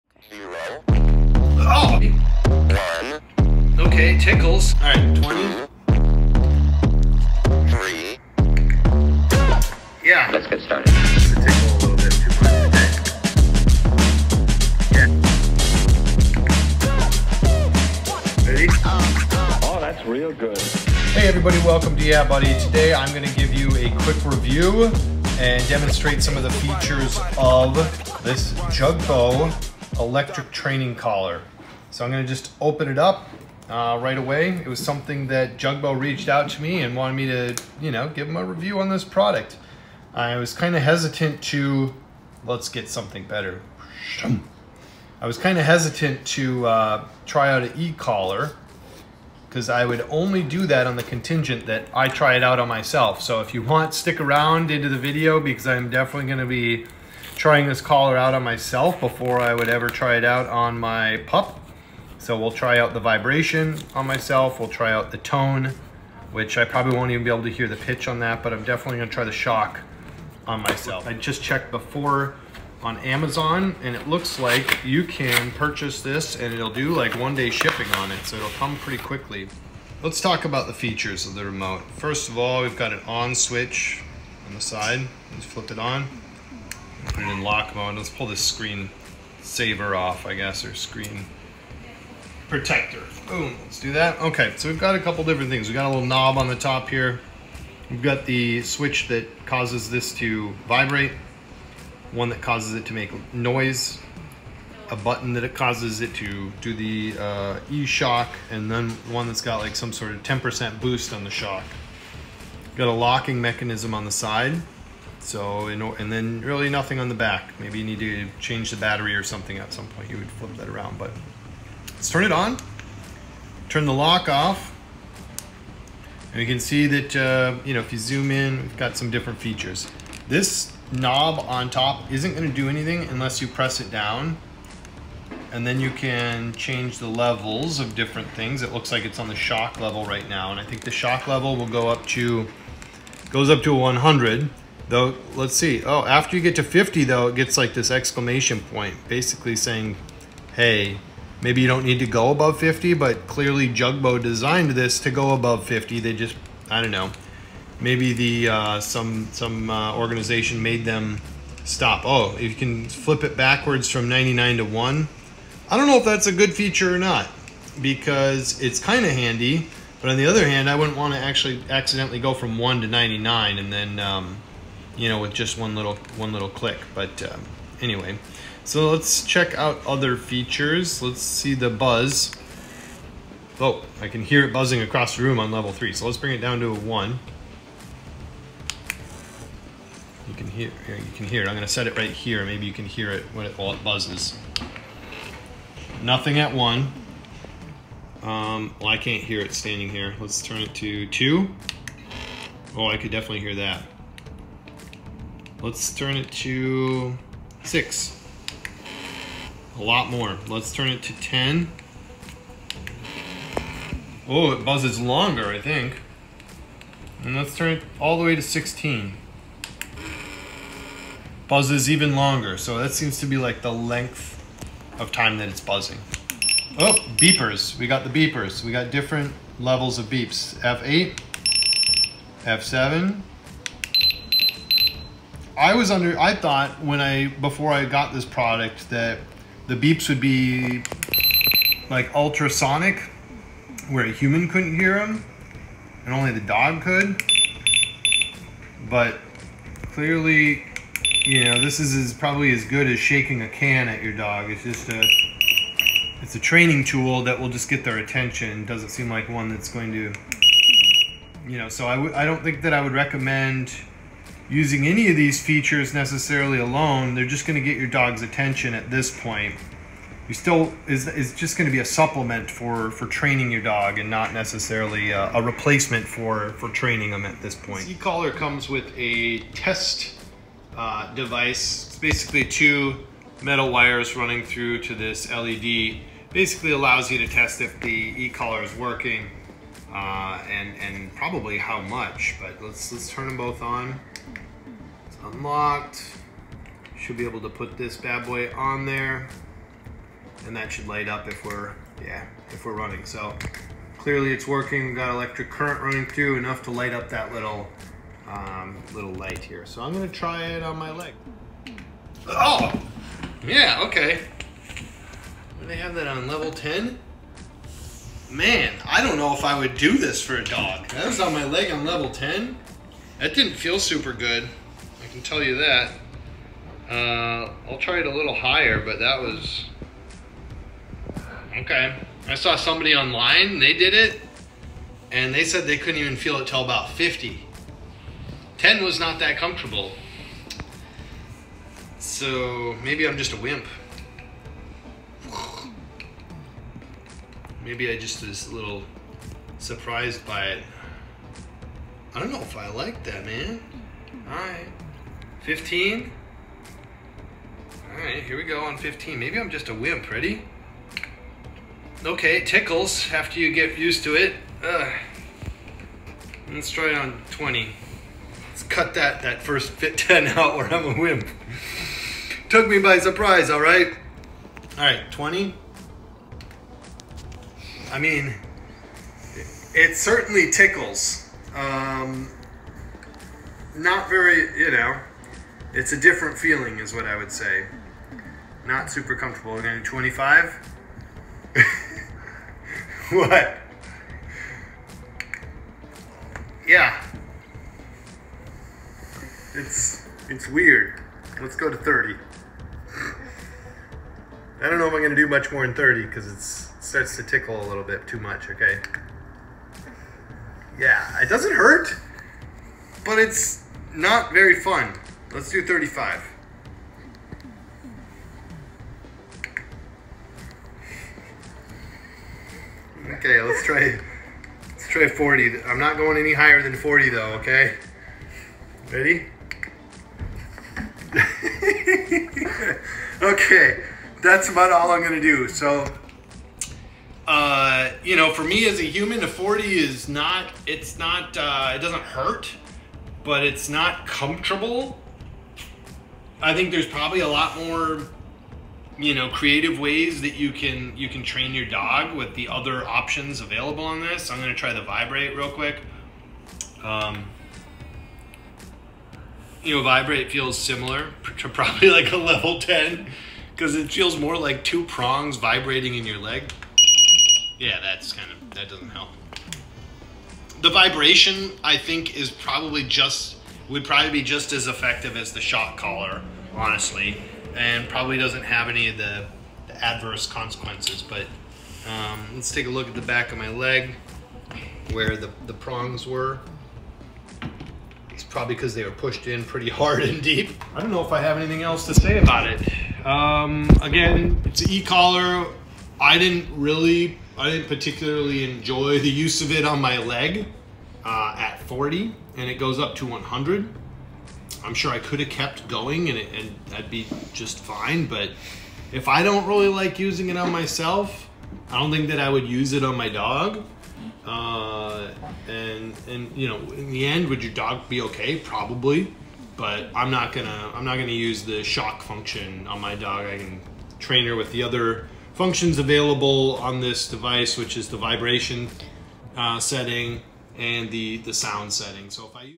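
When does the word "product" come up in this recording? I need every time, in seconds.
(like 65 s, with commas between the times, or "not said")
39 s, 238 s.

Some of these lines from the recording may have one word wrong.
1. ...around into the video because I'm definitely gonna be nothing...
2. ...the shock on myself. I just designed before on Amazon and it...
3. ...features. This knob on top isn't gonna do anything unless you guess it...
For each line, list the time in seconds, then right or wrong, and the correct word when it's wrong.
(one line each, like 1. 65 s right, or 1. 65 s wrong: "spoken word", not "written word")
1. 54 s wrong: "trying", not "nothing"
2. 69 s wrong: "checked", not "designed"
3. 129 s wrong: "press", not "guess".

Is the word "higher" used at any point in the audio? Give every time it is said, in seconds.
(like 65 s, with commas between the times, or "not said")
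328 s, 426 s.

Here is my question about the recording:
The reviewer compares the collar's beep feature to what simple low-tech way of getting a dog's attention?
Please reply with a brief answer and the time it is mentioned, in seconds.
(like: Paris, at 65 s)
shaking a can, at 252 s.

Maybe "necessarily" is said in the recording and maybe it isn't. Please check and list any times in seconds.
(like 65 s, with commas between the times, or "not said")
265 s, 274 s.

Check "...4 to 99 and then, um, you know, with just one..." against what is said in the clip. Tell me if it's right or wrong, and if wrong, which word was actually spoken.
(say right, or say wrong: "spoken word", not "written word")
wrong: "1", not "4".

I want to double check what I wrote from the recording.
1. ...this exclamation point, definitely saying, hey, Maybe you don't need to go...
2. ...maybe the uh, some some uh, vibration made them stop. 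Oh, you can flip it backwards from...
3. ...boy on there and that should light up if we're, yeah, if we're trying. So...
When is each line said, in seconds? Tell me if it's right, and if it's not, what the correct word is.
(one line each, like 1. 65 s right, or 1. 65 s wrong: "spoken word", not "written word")
1. 147 s wrong: "basically", not "definitely"
2. 157 s wrong: "organization", not "vibration"
3. 298 s wrong: "running", not "trying".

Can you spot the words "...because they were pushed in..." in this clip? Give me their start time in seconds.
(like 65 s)
488 s.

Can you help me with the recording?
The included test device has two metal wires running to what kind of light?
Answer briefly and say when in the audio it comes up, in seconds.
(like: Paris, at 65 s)
LED, at 285 s.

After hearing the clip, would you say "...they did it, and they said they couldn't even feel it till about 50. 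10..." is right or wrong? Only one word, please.
right.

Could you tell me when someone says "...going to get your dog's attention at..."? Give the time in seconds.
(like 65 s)
267 s.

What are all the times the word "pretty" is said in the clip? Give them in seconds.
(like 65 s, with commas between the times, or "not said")
78 s, 489 s.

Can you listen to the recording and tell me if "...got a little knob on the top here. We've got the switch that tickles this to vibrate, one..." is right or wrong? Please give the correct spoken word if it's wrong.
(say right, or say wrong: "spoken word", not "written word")
wrong: "causes", not "tickles".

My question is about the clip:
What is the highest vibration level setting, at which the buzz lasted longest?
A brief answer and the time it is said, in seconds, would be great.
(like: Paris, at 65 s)
16, at 218 s.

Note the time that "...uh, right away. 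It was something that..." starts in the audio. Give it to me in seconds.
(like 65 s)
33 s.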